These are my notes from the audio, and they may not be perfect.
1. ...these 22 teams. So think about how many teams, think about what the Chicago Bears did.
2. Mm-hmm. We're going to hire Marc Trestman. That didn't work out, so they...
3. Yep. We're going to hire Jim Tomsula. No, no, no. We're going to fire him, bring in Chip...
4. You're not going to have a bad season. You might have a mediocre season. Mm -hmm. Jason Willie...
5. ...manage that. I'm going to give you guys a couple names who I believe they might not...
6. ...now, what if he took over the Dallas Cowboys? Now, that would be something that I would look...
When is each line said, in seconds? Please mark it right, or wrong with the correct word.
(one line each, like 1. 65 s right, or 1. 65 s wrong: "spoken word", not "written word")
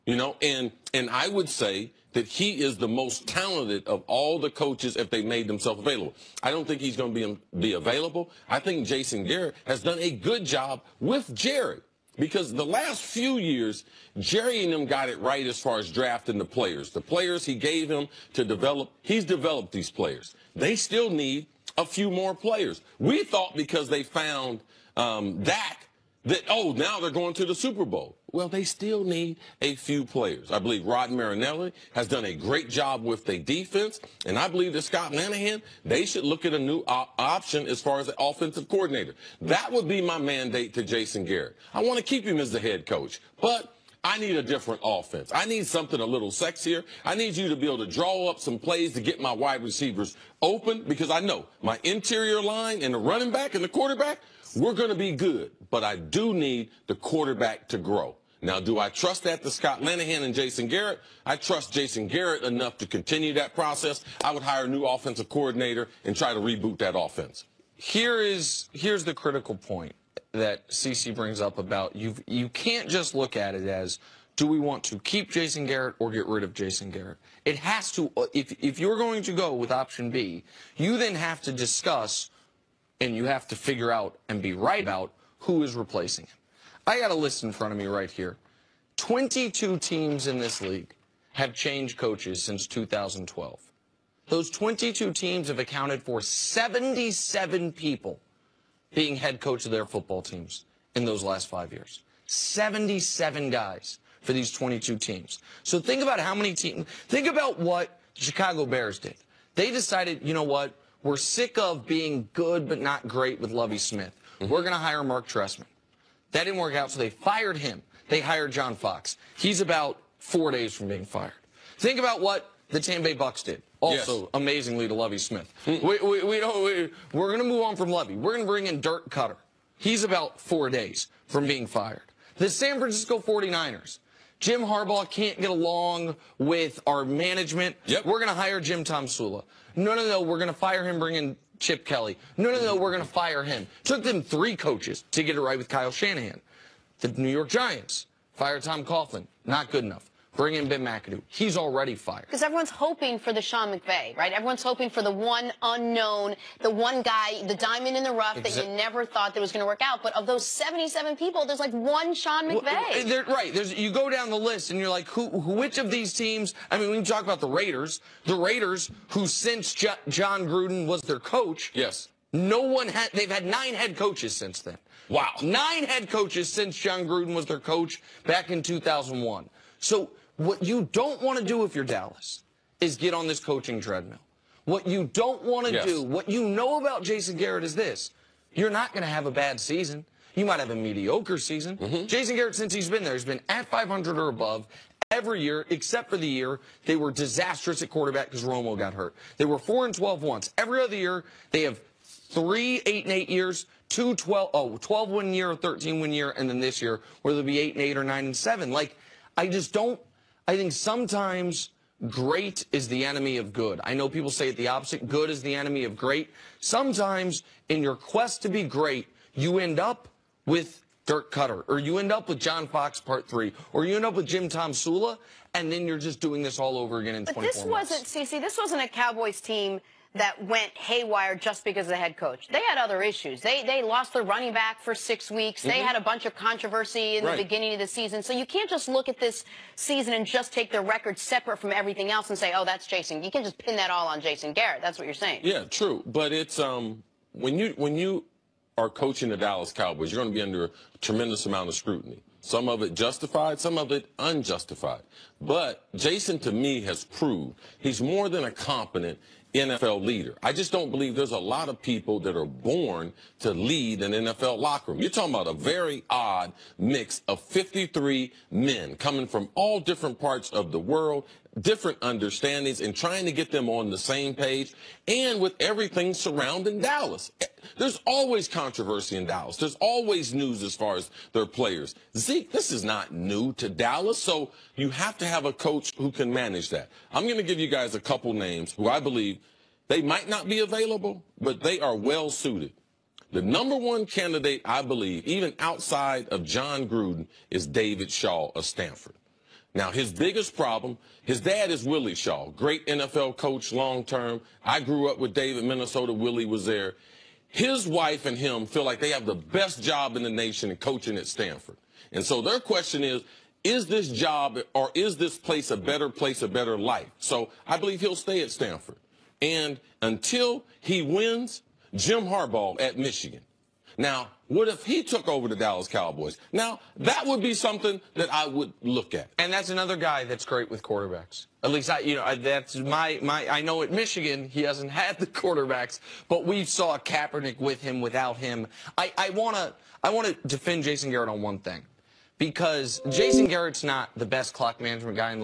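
1. 104 s right
2. 114 s right
3. 137 s right
4. 188 s wrong: "Garrett", not "Willie"
5. 286 s right
6. 323 s right.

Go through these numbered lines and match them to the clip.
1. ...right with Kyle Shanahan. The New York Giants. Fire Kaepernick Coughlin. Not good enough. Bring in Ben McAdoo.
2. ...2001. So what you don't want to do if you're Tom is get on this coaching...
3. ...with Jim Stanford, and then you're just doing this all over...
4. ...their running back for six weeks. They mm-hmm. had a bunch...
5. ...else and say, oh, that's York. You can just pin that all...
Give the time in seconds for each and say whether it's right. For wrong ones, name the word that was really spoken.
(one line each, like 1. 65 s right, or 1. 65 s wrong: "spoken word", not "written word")
1. 145 s wrong: "Tom", not "Kaepernick"
2. 178 s wrong: "Dallas", not "Tom"
3. 224 s wrong: "Tomsula", not "Stanford"
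4. 234 s right
5. 242 s wrong: "Jason", not "York".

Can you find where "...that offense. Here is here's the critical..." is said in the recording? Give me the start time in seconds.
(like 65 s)
66 s.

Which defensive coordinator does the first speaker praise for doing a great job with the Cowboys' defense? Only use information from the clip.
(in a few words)
Rod Marinelli.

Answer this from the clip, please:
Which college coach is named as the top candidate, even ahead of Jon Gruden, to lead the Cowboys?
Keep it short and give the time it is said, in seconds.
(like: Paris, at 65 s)
David Shaw, at 297 s.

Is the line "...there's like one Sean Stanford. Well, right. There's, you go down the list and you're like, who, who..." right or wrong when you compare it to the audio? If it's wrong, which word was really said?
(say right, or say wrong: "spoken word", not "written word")
wrong: "McVay", not "Stanford".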